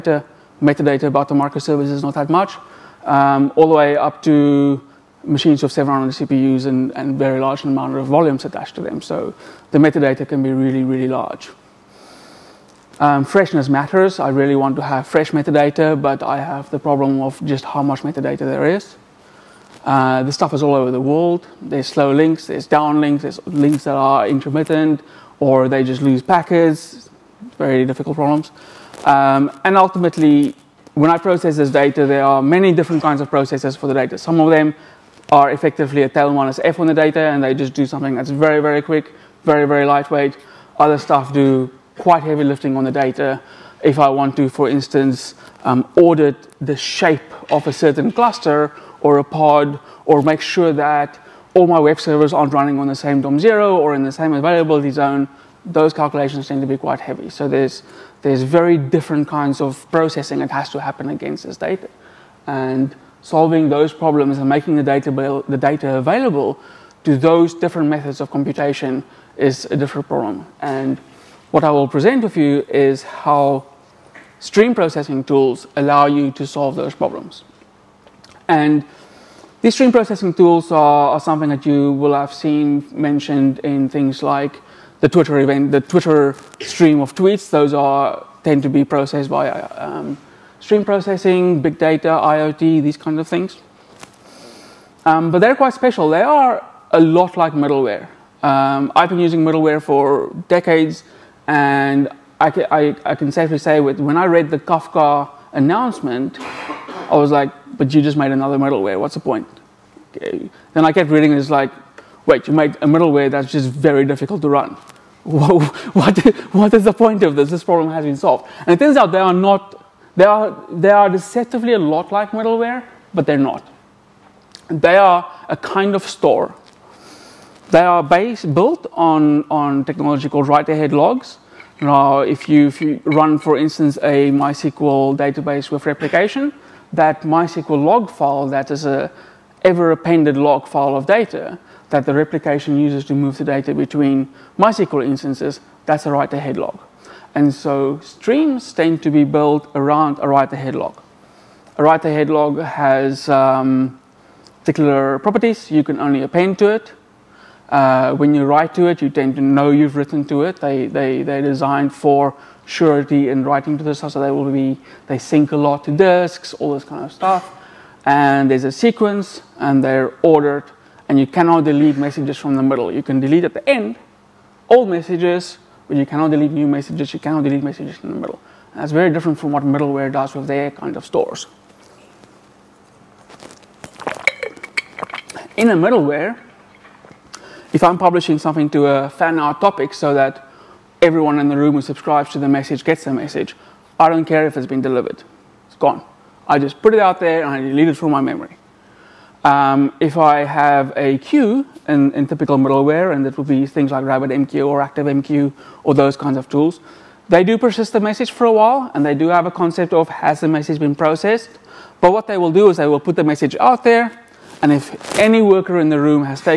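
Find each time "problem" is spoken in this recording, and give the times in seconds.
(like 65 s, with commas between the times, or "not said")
16 s, 28 s, 63 s, 70 s, 76 s, 117 s.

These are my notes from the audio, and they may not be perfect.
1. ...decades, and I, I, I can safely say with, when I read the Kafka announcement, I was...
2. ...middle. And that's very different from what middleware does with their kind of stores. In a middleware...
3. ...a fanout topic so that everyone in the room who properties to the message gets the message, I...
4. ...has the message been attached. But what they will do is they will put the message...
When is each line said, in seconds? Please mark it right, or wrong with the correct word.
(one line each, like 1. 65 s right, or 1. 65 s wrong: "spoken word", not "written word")
1. 100 s right
2. 178 s right
3. 188 s wrong: "subscribes", not "properties"
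4. 210 s wrong: "processed", not "attached".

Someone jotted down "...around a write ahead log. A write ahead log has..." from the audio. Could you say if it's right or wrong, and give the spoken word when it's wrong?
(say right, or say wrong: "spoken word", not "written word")
right.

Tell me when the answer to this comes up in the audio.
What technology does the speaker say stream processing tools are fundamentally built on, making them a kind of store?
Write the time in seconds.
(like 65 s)
130 s.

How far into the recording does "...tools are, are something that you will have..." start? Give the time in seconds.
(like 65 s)
80 s.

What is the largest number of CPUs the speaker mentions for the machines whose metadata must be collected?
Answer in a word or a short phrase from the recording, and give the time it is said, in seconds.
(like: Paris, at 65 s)
700, at 5 s.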